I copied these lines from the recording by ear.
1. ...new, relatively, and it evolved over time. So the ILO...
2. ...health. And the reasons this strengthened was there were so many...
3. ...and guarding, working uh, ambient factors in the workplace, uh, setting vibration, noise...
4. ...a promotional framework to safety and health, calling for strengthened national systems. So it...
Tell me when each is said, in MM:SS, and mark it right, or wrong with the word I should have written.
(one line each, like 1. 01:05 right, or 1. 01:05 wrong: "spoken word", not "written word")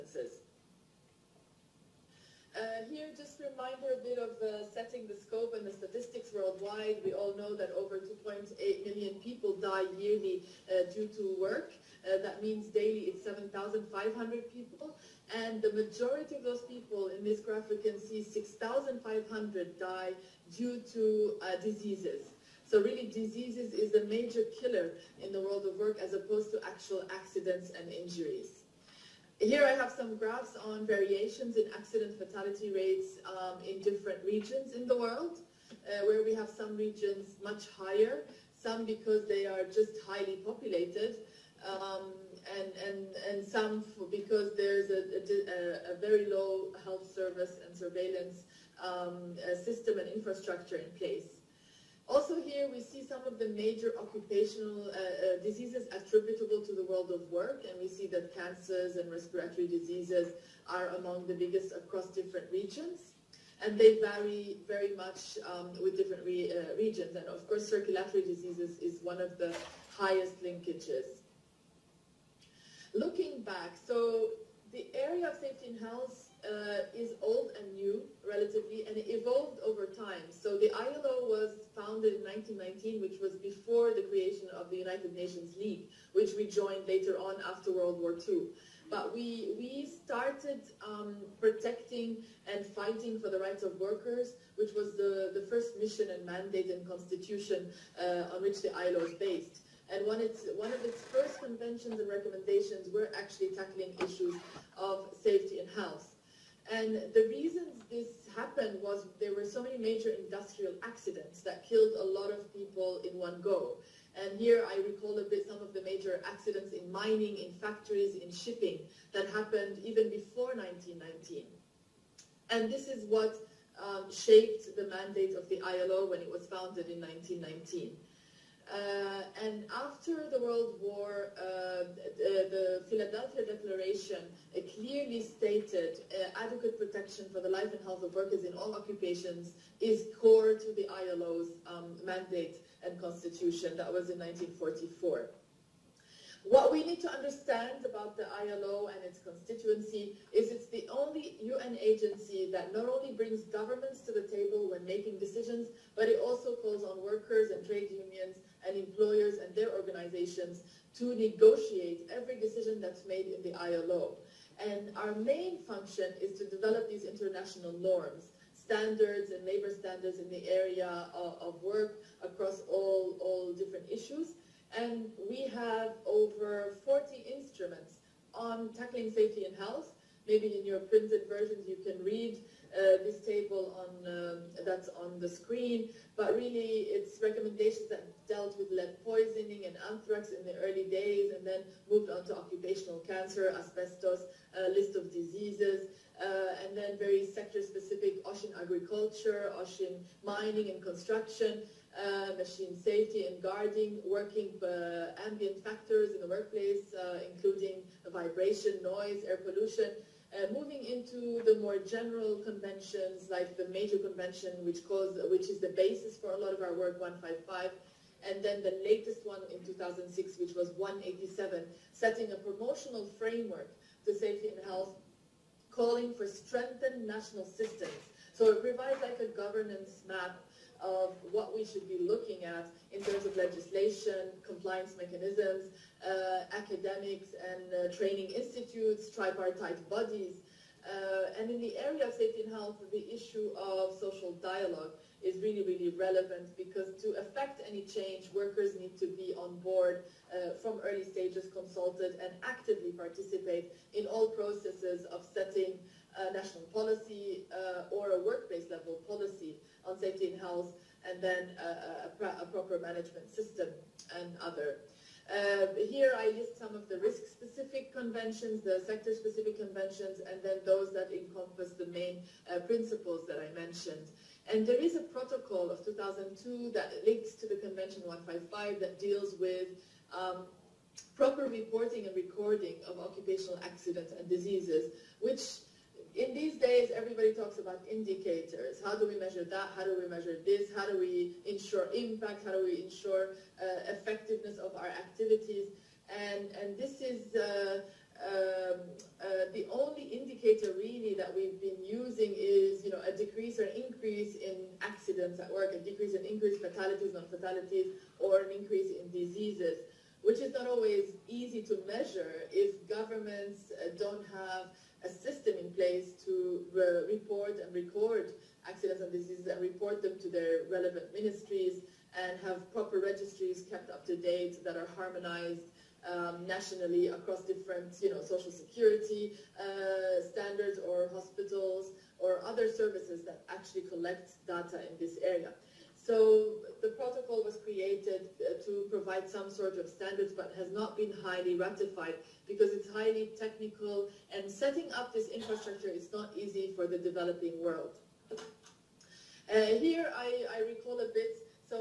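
1. 01:17 right
2. 01:45 wrong: "happened", not "strengthened"
3. 03:23 wrong: "including", not "setting"
4. 03:42 right.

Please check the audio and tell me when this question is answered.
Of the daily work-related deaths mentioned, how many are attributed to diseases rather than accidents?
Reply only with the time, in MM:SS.
00:18.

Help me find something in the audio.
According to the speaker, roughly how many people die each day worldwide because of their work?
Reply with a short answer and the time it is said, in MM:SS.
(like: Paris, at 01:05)
7,500, at 00:13.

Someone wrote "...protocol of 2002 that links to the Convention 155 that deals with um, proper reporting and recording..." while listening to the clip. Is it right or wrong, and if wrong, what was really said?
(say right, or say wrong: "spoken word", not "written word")
right.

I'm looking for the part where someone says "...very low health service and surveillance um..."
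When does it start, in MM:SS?
00:45.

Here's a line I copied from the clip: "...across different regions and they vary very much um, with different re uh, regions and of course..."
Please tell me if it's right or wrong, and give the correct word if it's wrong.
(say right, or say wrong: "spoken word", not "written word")
right.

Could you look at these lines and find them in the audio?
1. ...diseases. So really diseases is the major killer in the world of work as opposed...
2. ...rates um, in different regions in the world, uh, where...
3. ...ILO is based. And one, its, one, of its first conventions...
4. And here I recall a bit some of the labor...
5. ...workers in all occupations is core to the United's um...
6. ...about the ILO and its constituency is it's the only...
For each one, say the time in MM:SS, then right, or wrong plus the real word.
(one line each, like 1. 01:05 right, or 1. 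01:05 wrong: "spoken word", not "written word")
1. 00:21 right
2. 00:32 right
3. 01:38 right
4. 01:54 wrong: "major", not "labor"
5. 02:18 wrong: "ILO", not "United"
6. 02:27 right.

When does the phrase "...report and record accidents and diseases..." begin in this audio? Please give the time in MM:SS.
05:17.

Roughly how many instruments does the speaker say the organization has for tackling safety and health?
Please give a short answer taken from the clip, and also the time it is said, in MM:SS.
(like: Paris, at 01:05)
Over 40, at 02:56.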